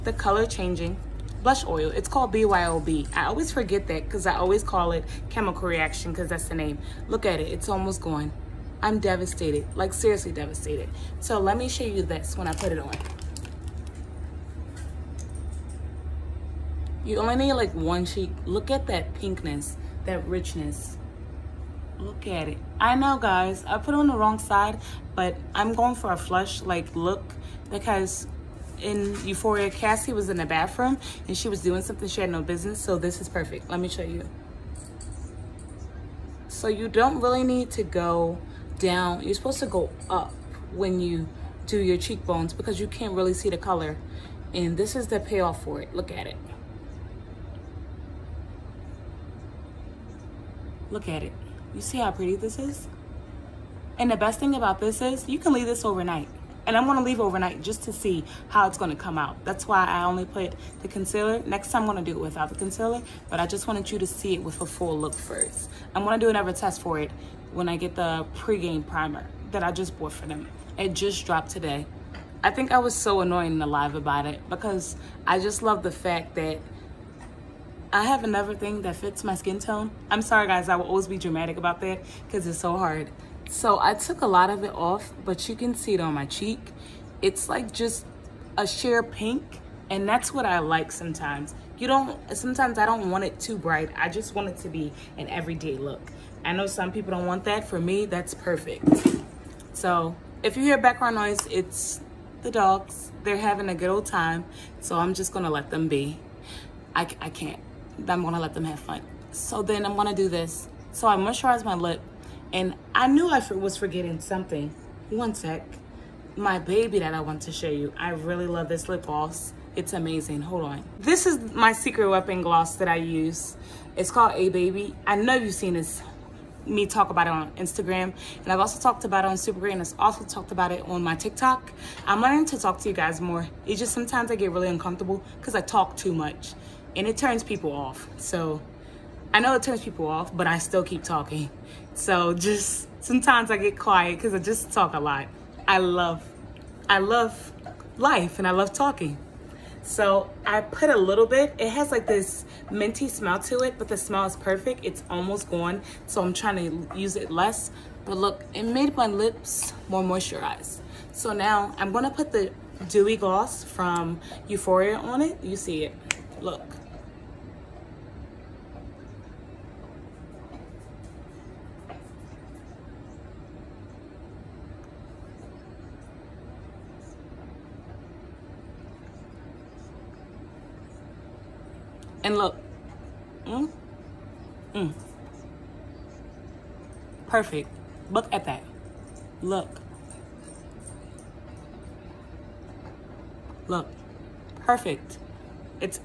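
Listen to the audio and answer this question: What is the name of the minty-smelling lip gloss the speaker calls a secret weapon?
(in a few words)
A Baby.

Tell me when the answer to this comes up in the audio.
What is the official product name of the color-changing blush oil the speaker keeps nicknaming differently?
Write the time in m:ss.
0:02.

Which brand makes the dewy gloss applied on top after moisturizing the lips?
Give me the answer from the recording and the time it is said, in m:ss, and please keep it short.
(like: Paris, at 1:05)
Youthforia, at 2:44.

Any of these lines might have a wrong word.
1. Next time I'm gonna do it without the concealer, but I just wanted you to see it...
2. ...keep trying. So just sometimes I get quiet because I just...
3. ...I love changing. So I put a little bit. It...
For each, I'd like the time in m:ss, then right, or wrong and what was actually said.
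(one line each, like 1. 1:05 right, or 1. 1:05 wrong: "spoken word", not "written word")
1. 1:01 right
2. 2:20 wrong: "talking", not "trying"
3. 2:28 wrong: "talking", not "changing".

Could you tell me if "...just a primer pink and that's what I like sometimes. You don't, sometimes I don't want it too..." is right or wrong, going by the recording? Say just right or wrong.
wrong.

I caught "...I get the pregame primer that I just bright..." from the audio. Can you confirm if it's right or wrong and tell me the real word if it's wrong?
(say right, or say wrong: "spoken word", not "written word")
wrong: "bought", not "bright".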